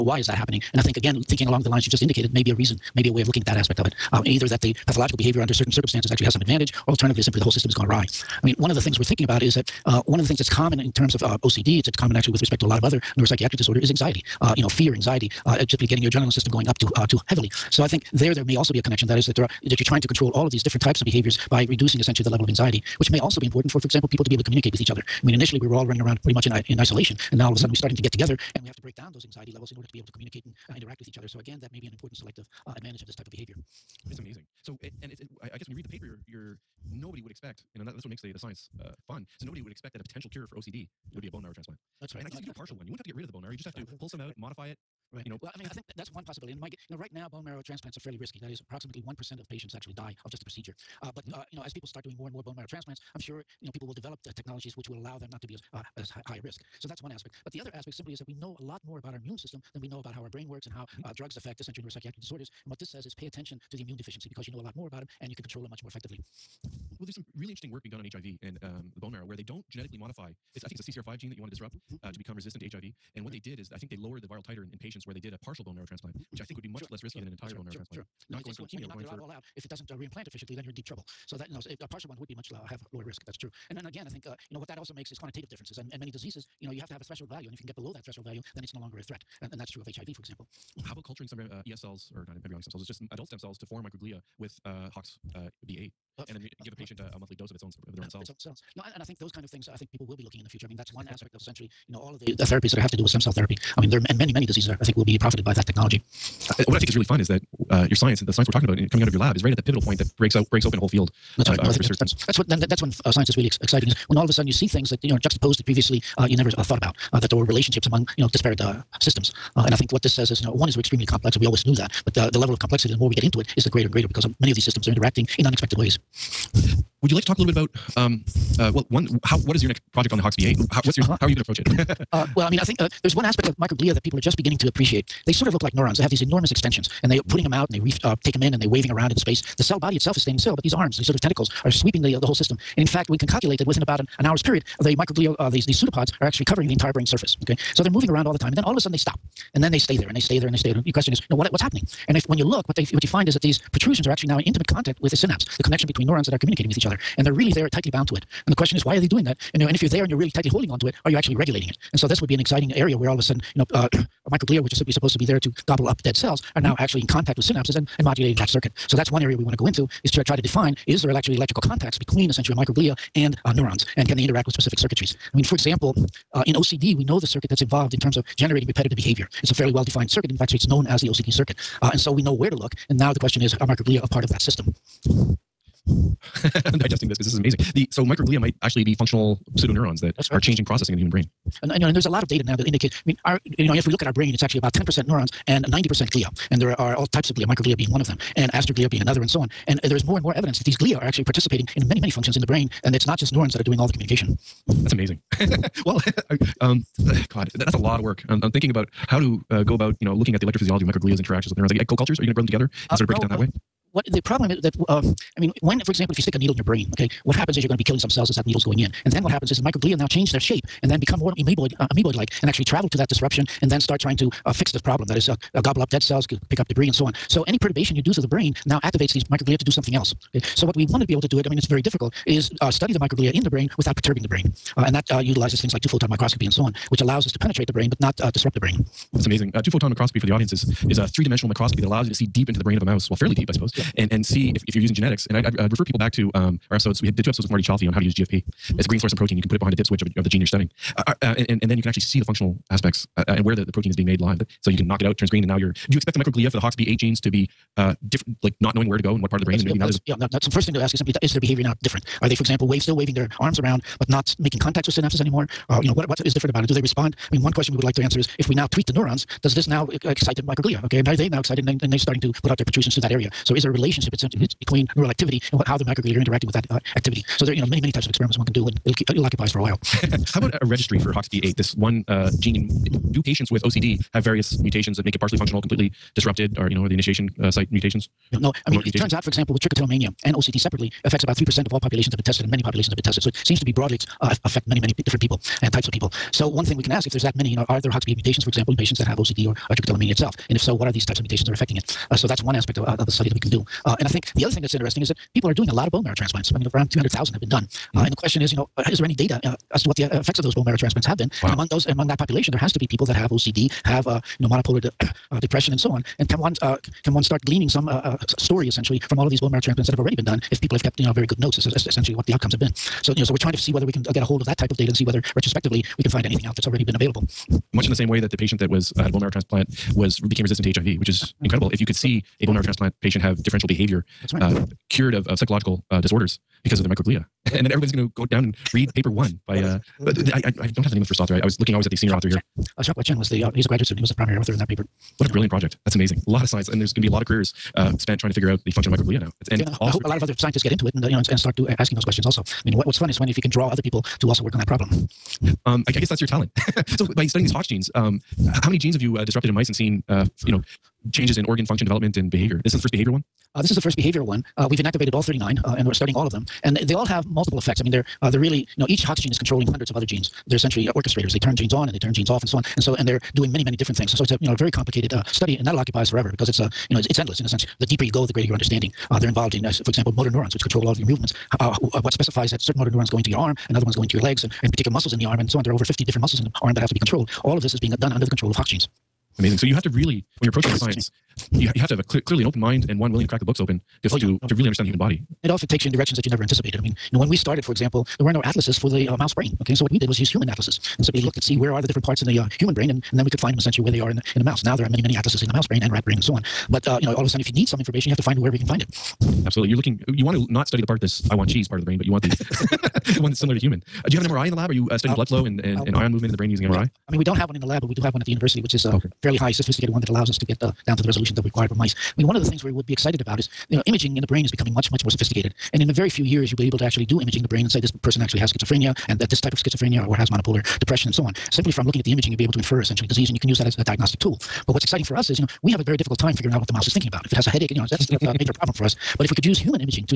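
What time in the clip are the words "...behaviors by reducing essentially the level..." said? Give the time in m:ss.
0:21.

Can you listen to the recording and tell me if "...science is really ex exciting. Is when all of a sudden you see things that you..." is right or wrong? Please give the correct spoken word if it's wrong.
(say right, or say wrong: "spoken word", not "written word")
right.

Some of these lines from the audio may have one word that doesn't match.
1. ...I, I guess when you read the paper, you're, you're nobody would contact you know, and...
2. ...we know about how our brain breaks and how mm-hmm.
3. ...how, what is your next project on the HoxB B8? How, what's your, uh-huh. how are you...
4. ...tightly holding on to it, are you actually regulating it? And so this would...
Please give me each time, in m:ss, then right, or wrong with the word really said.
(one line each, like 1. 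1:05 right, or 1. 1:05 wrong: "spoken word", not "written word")
1. 0:35 wrong: "expect", not "contact"
2. 0:59 wrong: "works", not "breaks"
3. 2:09 wrong: "Hawks", not "HoxB"
4. 2:40 right.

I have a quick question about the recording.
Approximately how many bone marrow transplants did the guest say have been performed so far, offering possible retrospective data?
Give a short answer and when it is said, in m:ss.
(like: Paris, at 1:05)
200,000, at 5:06.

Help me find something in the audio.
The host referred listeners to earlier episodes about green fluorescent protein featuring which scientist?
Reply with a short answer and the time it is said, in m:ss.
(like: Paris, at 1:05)
Marty Chalfie, at 4:07.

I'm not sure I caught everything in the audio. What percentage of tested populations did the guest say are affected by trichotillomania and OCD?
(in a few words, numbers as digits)
3%.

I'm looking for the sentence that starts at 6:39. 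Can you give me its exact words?
Okay, and so what we did was use human atlases and simply looked at see mm-hmm.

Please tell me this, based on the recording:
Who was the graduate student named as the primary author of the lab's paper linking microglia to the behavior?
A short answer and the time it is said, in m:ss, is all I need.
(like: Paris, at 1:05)
Ashok Chen, at 5:42.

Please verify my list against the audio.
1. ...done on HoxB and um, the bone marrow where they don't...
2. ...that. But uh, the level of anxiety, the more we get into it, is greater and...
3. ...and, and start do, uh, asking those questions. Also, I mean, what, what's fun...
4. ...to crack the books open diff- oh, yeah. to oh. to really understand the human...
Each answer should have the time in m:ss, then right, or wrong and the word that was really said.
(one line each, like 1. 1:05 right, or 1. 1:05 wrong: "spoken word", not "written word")
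1. 1:07 wrong: "HIV", not "HoxB"
2. 2:01 wrong: "complexity", not "anxiety"
3. 5:51 right
4. 6:33 right.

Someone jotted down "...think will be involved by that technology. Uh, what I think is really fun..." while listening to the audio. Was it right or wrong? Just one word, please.
wrong.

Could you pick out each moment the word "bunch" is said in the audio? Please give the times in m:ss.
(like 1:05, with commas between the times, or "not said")
not said.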